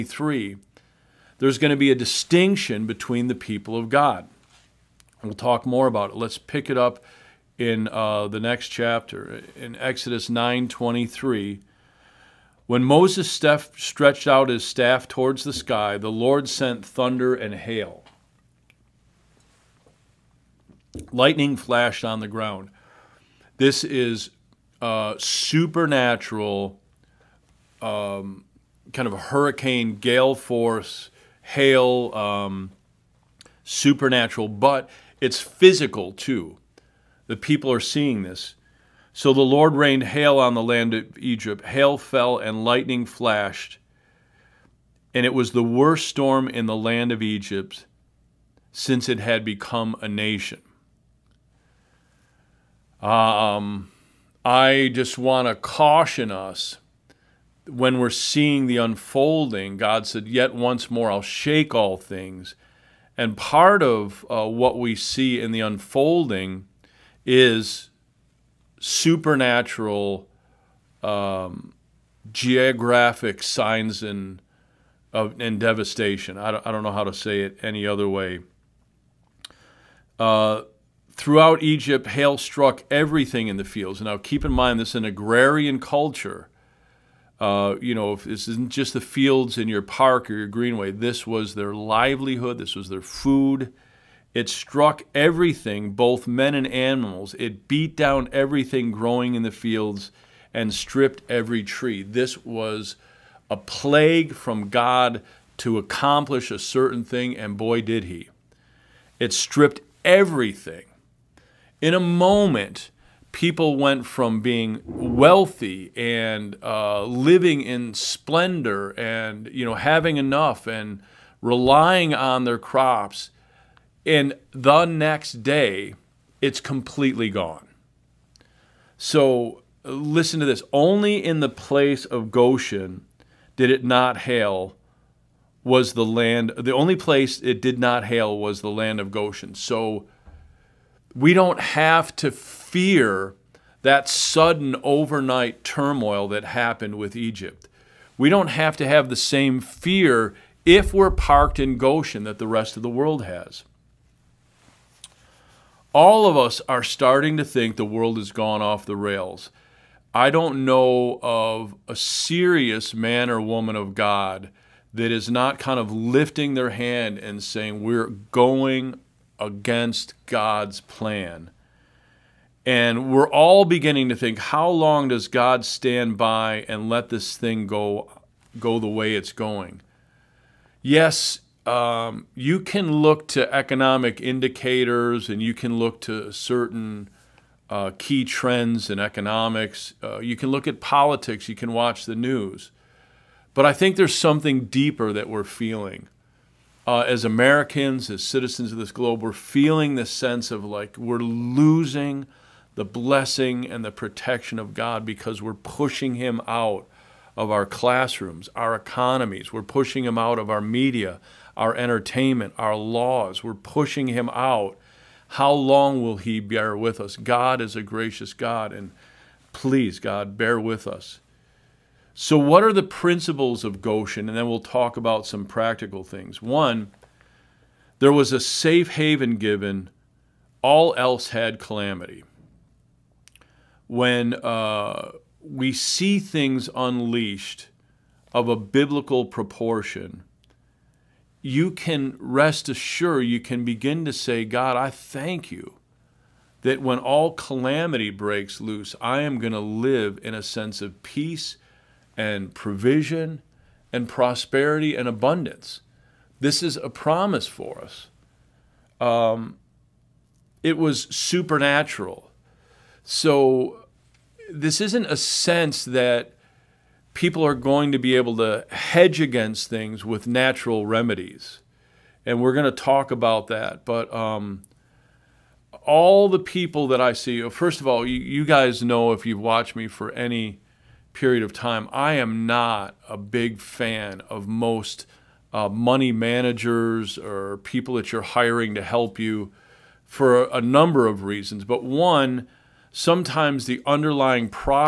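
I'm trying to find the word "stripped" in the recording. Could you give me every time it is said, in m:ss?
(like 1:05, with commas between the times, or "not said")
1:40, 1:49.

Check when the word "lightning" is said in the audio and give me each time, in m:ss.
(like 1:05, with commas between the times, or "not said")
0:21, 0:42.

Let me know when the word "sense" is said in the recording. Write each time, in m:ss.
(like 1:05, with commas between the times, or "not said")
3:20, 4:10, 4:25.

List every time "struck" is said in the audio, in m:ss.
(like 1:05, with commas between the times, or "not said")
1:22, 1:34.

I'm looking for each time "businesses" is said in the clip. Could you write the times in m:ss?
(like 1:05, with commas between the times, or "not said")
not said.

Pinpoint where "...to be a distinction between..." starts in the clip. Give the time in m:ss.
0:01.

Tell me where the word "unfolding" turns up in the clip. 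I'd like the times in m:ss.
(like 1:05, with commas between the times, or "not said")
0:58, 1:05.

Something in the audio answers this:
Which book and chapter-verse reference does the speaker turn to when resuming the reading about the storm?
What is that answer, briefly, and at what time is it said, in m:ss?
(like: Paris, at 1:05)
Exodus 9:23, at 0:09.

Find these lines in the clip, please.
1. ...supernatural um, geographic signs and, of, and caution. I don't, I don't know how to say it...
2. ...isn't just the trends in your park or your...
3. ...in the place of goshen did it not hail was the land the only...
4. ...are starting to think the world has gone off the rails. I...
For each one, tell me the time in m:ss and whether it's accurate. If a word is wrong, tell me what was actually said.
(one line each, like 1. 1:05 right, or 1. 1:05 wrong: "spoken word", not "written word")
1. 1:08 wrong: "devastation", not "caution"
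2. 1:28 wrong: "fields", not "trends"
3. 2:11 right
4. 2:36 right.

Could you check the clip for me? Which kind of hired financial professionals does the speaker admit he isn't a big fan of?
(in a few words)
Money managers.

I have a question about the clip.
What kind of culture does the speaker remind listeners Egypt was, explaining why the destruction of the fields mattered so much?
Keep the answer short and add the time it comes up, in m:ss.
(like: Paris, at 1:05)
Agrarian, at 1:25.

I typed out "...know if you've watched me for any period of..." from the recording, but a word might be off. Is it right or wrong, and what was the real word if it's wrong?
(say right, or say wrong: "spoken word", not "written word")
right.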